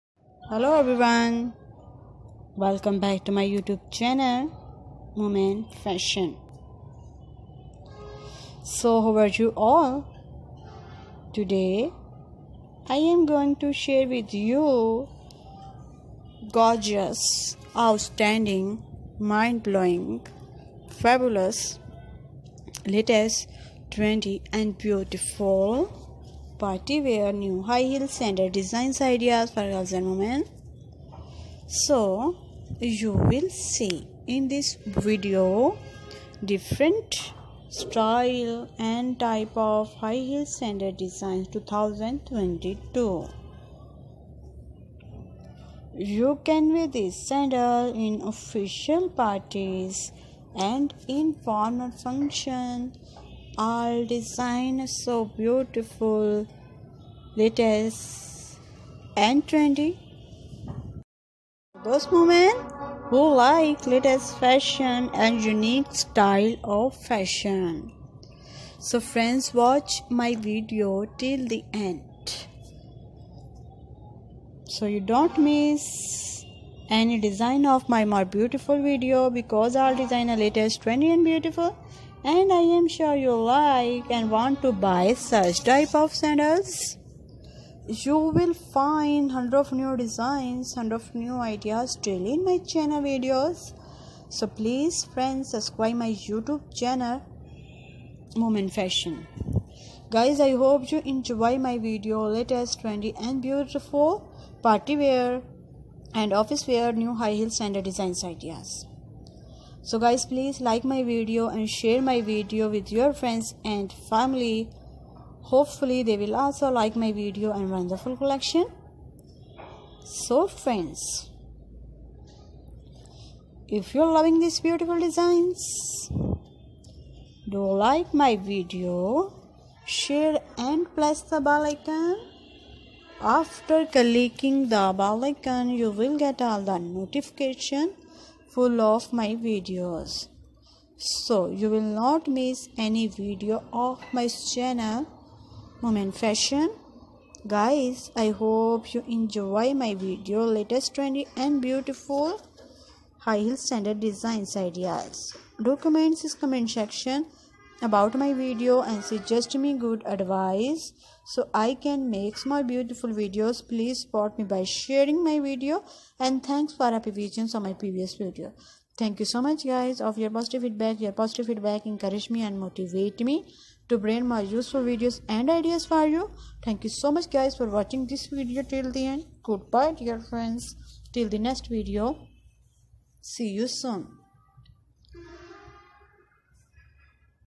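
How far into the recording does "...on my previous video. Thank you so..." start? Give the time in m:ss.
2:47.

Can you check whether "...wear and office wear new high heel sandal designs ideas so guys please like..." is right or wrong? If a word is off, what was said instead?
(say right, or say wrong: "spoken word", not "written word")
right.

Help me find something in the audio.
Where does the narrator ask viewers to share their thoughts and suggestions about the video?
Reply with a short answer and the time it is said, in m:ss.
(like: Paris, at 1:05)
Comment section, at 2:36.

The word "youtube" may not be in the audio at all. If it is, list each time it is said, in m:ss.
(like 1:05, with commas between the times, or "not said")
0:03, 1:36.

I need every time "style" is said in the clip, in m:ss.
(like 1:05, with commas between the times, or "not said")
0:37, 1:05.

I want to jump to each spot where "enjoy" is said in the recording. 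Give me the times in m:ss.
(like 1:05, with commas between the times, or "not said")
1:41, 2:29.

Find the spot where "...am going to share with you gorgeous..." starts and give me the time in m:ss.
0:12.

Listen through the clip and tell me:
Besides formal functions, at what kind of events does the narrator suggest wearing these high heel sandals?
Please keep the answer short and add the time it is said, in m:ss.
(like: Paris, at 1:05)
Official parties, at 0:48.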